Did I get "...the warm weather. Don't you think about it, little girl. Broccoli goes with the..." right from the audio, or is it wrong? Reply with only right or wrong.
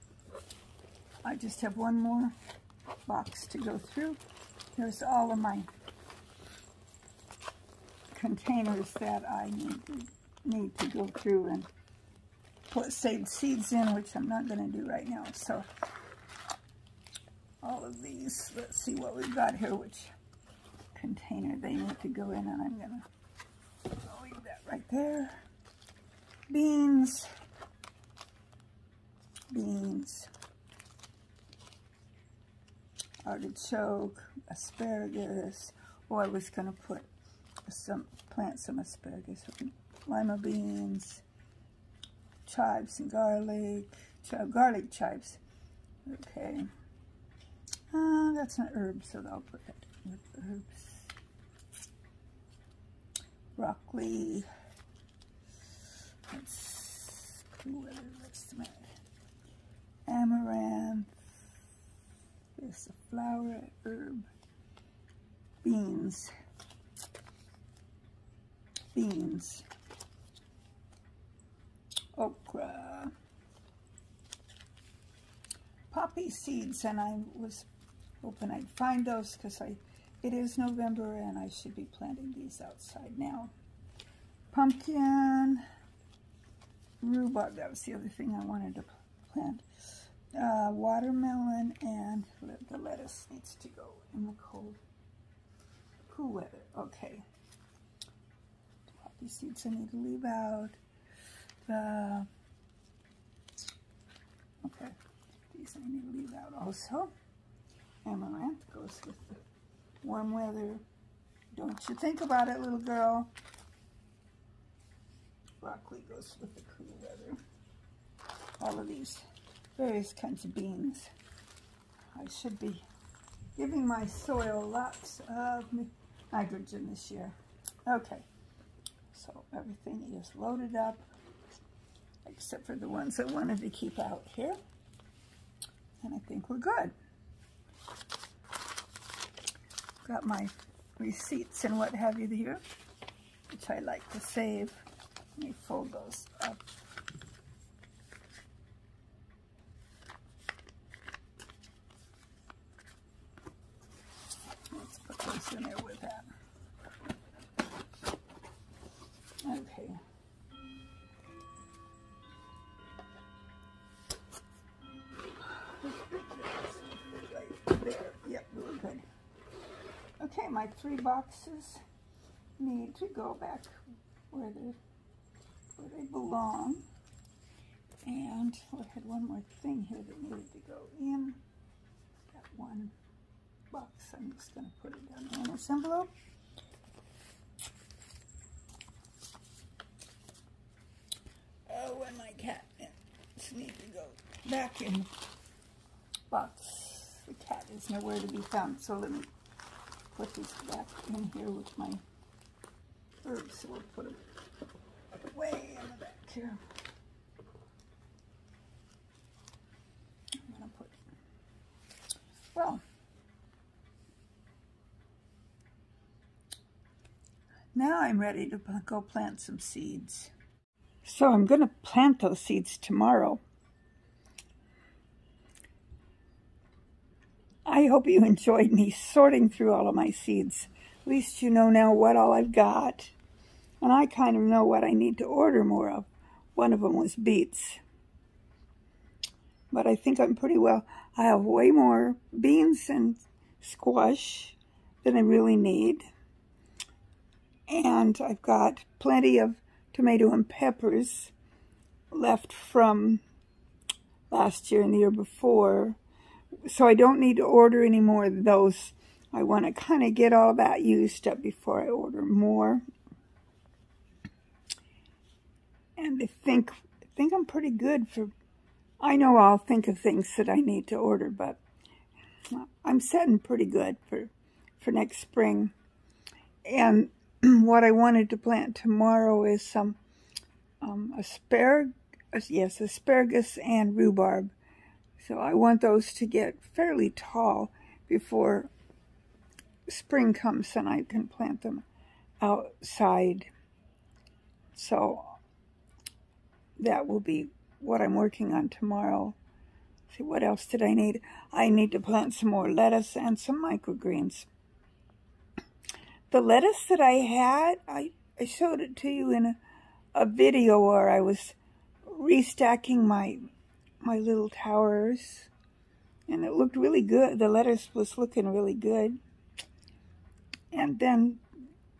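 right.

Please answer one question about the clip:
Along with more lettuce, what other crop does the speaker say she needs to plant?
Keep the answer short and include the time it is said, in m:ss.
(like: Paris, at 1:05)
Microgreens, at 5:03.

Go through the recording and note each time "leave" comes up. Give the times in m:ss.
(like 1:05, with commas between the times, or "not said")
0:24, 1:39, 1:46.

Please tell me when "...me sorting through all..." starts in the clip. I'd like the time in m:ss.
3:48.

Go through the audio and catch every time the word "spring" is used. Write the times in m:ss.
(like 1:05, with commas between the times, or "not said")
4:35, 4:49.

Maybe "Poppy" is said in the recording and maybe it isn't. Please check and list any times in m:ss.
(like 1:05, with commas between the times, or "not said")
1:15, 1:39.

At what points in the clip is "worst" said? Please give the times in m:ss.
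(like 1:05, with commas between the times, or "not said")
not said.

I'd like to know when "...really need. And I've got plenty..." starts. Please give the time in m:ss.
4:05.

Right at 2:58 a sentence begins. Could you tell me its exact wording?
And I had one more thing here that needed to go in.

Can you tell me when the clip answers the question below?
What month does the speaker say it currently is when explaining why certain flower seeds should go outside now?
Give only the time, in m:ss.
1:20.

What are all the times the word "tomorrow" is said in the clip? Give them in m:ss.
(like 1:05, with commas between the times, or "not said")
3:42, 4:38, 4:58.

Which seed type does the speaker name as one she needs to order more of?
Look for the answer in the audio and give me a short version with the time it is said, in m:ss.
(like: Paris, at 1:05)
Beets, at 3:57.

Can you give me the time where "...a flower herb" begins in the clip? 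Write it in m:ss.
1:02.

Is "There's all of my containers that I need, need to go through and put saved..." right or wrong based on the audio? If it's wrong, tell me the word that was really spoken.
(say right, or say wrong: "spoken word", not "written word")
right.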